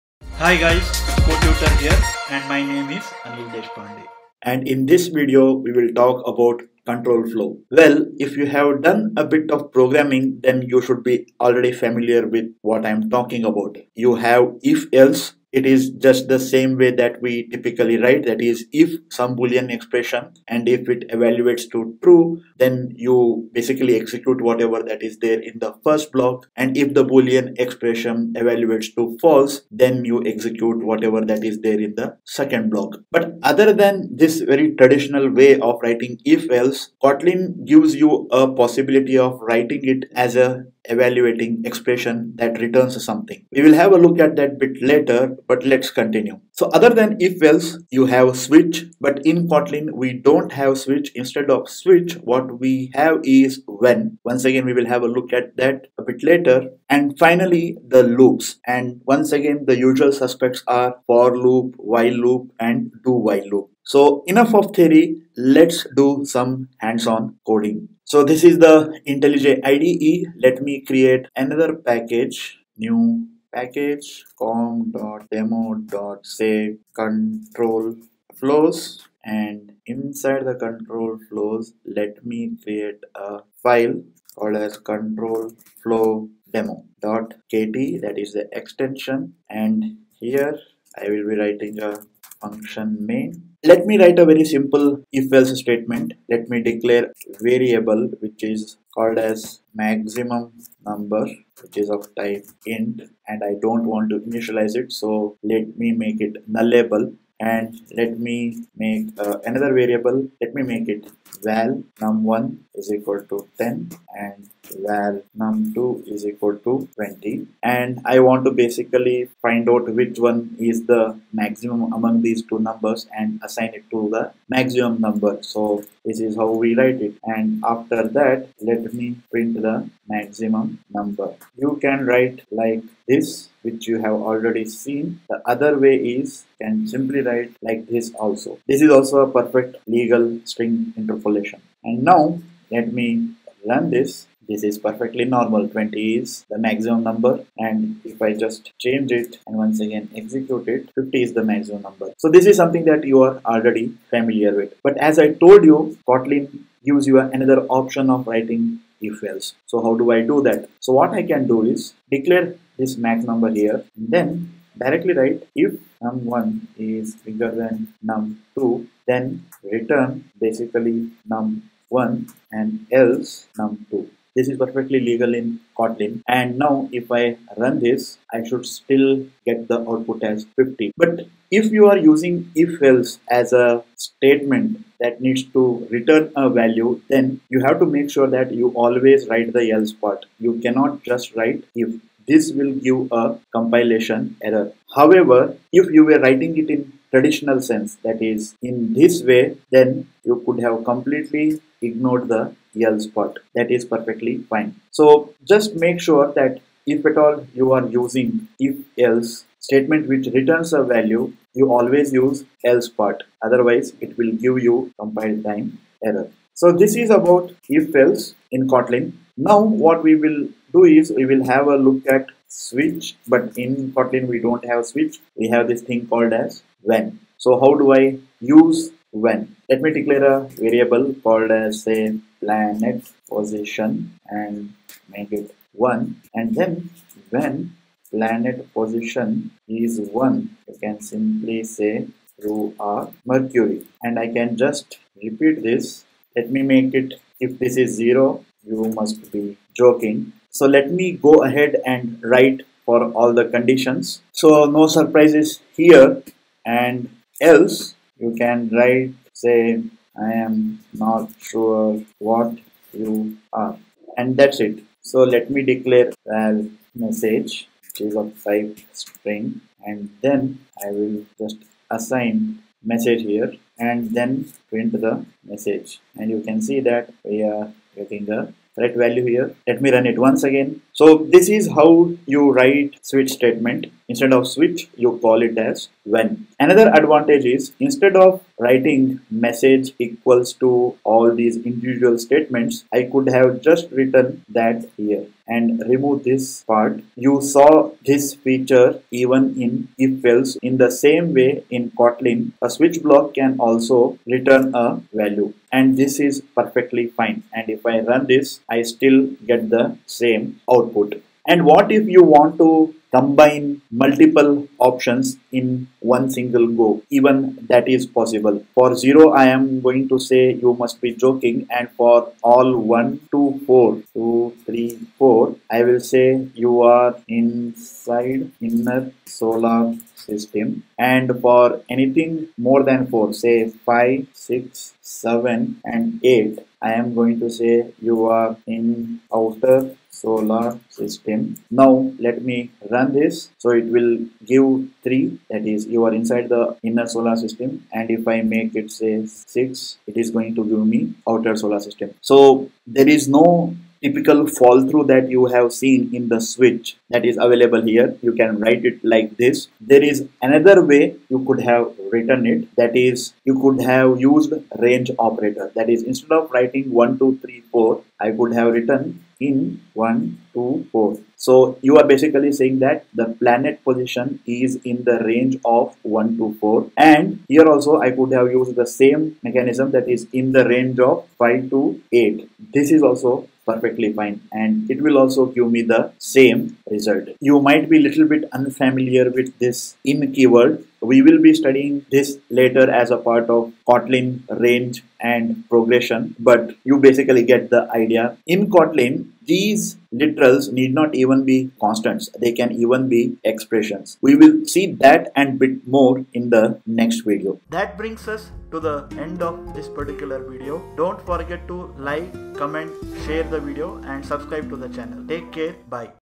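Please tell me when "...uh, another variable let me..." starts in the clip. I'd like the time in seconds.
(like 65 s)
109 s.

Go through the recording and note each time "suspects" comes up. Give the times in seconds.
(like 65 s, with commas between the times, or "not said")
60 s.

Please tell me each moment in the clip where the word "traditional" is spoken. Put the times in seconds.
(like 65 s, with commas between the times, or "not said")
34 s, 197 s.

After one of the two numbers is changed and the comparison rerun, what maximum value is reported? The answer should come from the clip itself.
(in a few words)
50.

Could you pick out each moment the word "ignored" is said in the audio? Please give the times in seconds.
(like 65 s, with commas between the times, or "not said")
201 s.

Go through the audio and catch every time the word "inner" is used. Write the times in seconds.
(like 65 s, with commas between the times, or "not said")
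328 s, 346 s.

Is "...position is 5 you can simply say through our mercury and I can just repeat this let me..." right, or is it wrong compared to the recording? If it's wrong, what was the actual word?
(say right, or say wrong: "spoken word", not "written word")
wrong: "1", not "5".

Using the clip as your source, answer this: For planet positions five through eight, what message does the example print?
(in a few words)
You are in outer solar system.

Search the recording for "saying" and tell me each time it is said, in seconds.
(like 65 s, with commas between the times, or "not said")
372 s.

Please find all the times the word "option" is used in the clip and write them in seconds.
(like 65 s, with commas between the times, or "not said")
157 s, 314 s.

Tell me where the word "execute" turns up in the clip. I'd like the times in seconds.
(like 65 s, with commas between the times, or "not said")
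23 s, 30 s, 150 s.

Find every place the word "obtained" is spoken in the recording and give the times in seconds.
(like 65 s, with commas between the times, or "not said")
not said.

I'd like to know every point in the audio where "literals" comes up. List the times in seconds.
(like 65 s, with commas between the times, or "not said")
400 s.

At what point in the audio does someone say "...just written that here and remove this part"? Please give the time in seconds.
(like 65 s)
293 s.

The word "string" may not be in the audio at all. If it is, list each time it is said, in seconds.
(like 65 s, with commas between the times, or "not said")
140 s, 268 s.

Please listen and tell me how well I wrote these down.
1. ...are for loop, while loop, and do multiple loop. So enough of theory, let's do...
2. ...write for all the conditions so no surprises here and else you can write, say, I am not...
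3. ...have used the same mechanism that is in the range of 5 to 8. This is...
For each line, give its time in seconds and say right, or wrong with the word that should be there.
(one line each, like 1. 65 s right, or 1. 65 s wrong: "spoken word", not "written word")
1. 60 s wrong: "while", not "multiple"
2. 252 s right
3. 378 s right.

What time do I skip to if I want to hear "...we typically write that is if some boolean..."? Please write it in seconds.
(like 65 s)
17 s.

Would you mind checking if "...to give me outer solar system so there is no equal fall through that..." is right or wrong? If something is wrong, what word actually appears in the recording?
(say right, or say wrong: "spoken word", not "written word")
wrong: "typical", not "equal".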